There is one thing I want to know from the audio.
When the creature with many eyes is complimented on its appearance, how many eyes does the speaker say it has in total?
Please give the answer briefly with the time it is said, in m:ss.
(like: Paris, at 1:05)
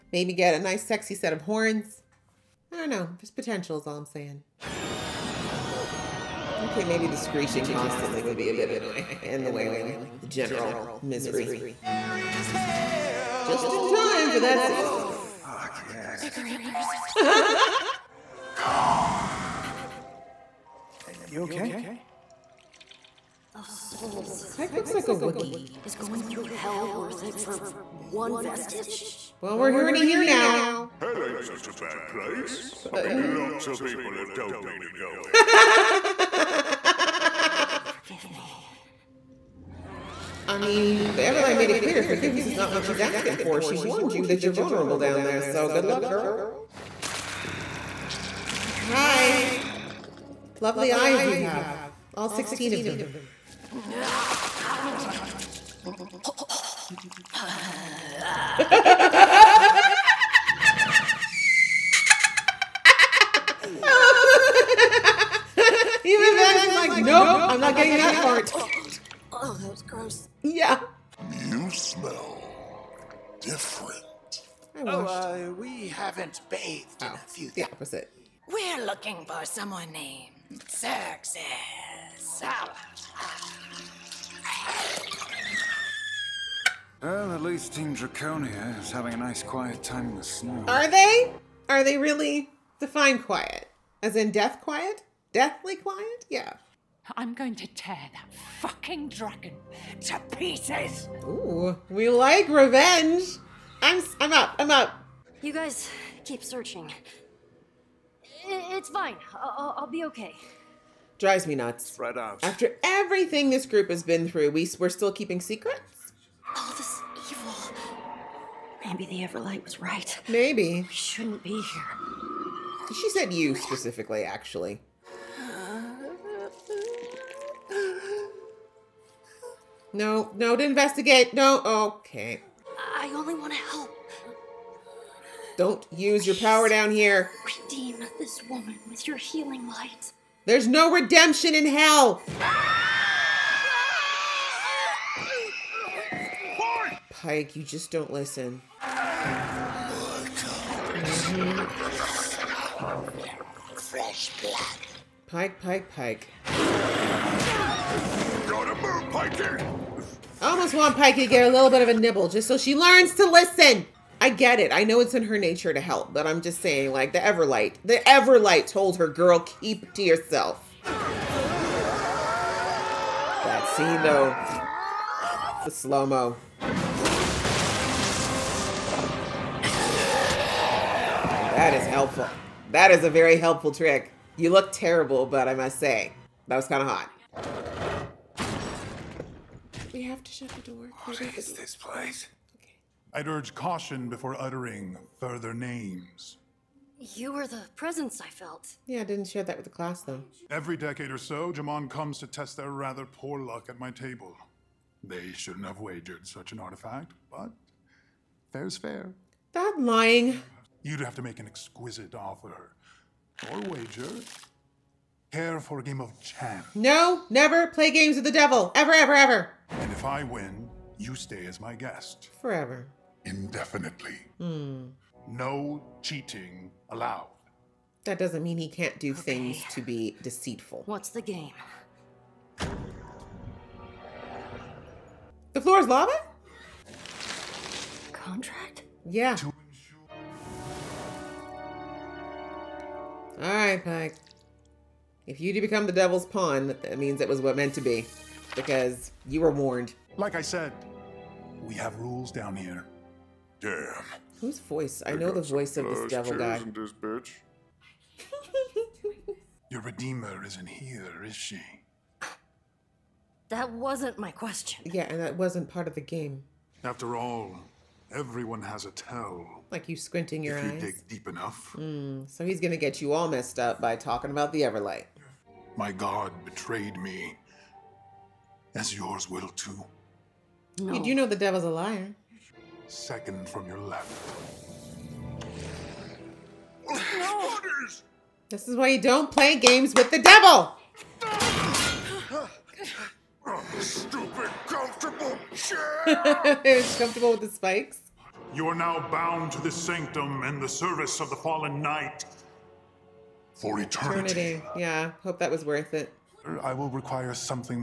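16, at 0:52.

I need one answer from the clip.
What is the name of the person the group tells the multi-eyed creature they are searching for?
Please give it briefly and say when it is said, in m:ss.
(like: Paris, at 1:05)
Zerxus, at 1:20.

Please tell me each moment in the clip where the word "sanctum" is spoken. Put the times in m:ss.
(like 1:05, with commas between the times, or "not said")
4:59.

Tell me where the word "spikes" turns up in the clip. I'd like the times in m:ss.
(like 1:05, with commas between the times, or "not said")
4:57.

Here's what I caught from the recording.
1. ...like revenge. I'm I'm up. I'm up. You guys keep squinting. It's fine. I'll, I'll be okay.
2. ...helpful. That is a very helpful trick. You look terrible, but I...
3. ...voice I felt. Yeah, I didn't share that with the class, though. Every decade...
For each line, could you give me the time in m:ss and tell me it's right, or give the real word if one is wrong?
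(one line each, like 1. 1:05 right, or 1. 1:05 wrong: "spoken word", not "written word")
1. 1:42 wrong: "searching", not "squinting"
2. 3:01 right
3. 3:17 wrong: "presence", not "voice".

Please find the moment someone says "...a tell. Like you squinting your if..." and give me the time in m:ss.
4:28.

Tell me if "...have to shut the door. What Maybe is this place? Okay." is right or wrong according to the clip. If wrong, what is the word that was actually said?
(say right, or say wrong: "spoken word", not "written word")
right.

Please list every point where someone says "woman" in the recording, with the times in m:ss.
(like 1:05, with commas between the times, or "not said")
2:18.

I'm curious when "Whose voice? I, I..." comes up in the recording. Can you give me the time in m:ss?
4:14.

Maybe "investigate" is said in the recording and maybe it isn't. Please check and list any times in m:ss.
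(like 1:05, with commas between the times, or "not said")
2:10.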